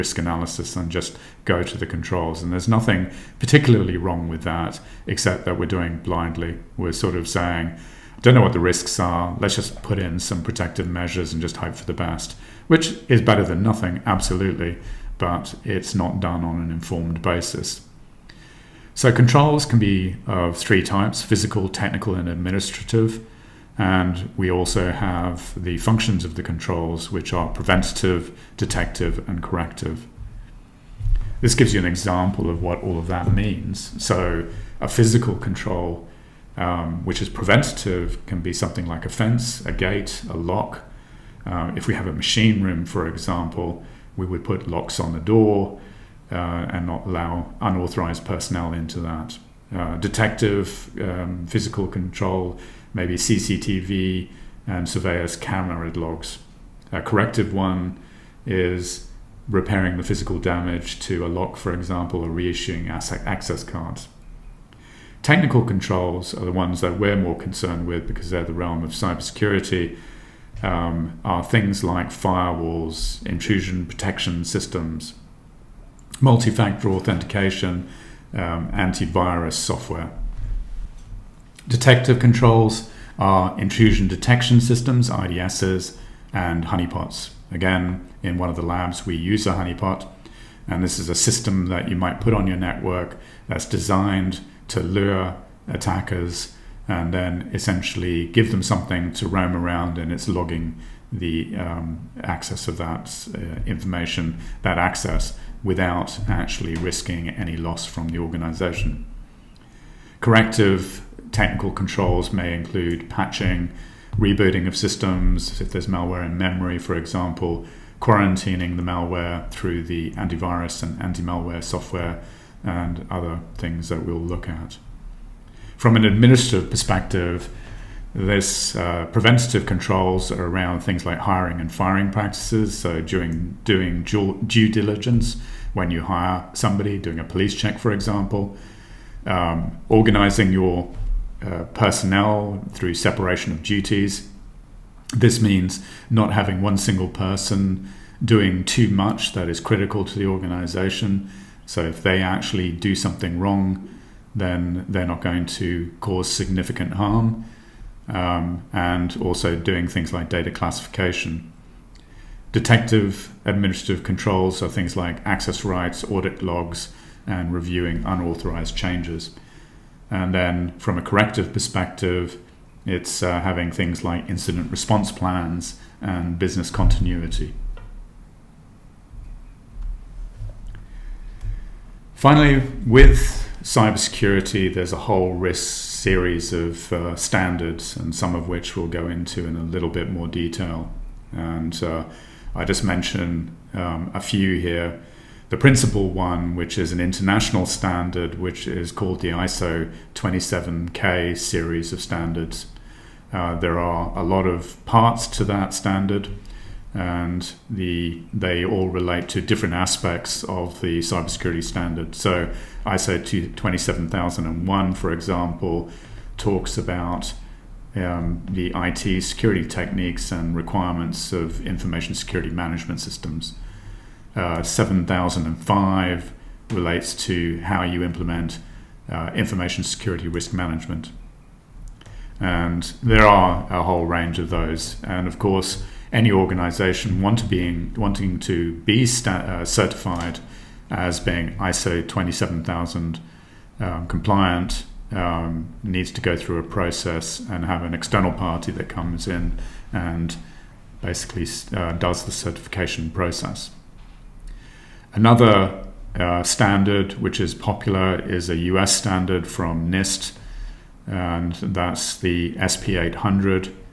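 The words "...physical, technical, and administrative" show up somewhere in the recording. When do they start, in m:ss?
0:21.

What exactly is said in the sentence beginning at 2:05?
From an administrative perspective, there's uh, preventative controls around things like hiring and firing practices.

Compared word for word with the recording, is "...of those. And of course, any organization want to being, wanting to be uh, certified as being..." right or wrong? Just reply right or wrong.
right.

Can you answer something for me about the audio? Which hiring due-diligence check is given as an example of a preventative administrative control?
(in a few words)
Police check.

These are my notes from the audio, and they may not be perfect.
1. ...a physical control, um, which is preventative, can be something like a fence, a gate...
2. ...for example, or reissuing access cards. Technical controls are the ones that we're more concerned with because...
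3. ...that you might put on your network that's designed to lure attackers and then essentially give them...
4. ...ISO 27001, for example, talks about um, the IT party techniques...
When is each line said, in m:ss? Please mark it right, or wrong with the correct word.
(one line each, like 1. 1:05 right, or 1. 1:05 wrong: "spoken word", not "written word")
1. 0:34 right
2. 1:01 right
3. 1:31 right
4. 3:32 wrong: "security", not "party".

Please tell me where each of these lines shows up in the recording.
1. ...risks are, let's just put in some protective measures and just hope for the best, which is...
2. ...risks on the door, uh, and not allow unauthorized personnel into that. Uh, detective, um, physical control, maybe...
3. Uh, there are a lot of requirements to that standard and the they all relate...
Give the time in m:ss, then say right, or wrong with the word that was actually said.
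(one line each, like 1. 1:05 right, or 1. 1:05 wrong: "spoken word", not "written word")
1. 0:08 right
2. 0:44 wrong: "locks", not "risks"
3. 3:23 wrong: "parts", not "requirements".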